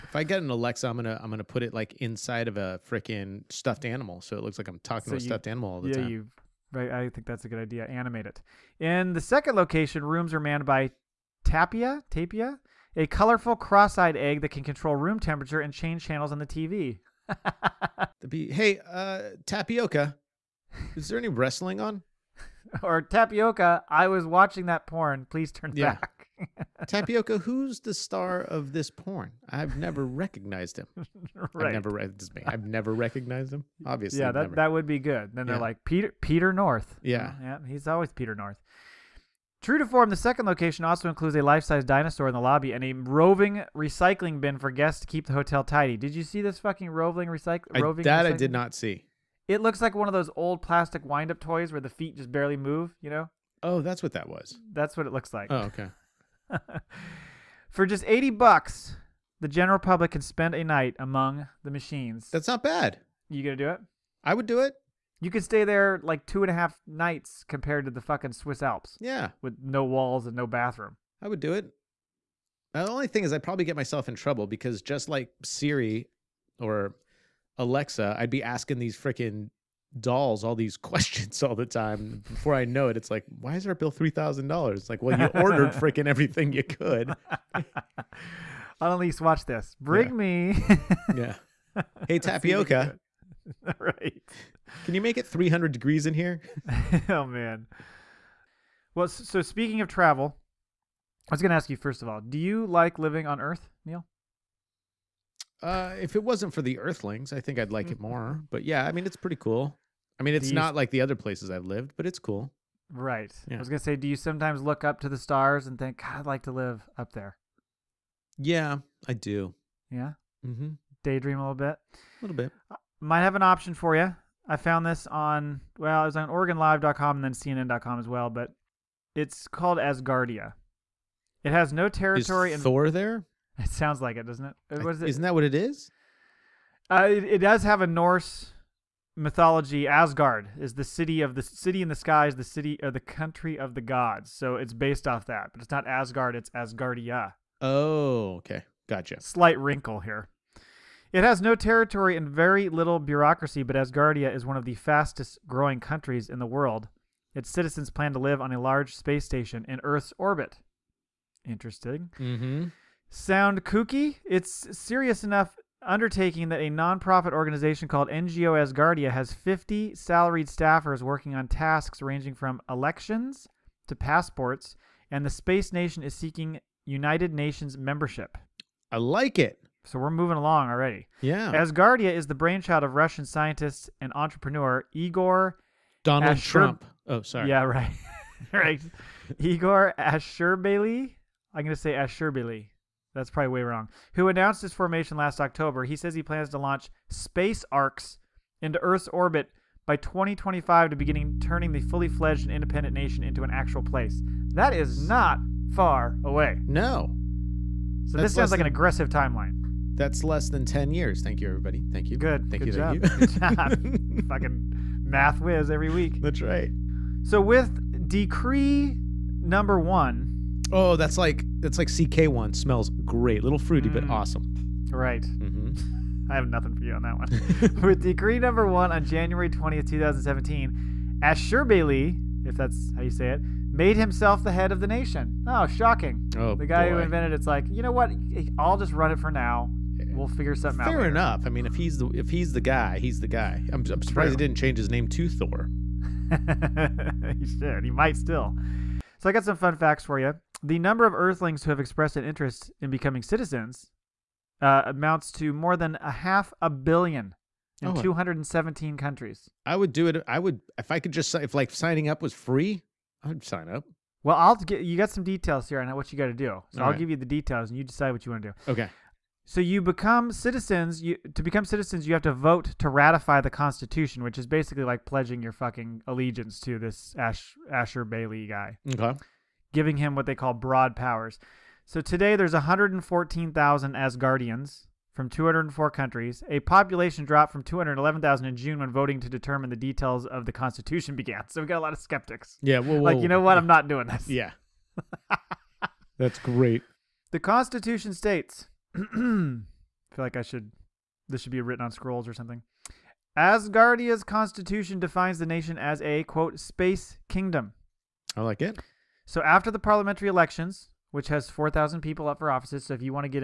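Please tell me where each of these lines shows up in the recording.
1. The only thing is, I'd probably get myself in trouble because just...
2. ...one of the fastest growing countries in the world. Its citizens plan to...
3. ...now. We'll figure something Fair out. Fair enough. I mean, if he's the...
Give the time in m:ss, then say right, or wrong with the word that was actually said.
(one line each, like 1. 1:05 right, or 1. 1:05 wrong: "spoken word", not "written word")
1. 1:12 right
2. 2:34 right
3. 3:59 right.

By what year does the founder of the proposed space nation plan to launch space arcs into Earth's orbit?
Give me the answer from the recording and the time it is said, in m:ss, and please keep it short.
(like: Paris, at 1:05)
2025, at 3:19.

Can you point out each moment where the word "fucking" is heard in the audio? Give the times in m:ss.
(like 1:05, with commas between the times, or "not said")
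0:46, 1:08, 3:34, 4:35.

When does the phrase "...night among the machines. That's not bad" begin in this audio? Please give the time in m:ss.
1:00.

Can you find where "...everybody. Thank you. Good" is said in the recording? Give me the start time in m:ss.
3:31.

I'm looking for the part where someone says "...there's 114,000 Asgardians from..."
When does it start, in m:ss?
4:42.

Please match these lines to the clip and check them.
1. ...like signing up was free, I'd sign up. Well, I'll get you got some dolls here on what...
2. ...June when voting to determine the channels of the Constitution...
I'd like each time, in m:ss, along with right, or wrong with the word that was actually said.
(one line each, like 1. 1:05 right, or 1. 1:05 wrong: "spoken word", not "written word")
1. 4:21 wrong: "details", not "dolls"
2. 4:48 wrong: "details", not "channels".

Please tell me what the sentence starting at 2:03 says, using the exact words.
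might have an option for you.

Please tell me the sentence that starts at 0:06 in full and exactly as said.
Yeah, you I think that's a good idea.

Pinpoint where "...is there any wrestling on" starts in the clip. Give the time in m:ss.
0:20.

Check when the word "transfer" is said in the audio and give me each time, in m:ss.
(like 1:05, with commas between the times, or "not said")
not said.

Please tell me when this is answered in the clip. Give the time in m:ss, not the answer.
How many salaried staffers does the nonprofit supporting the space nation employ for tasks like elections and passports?
2:49.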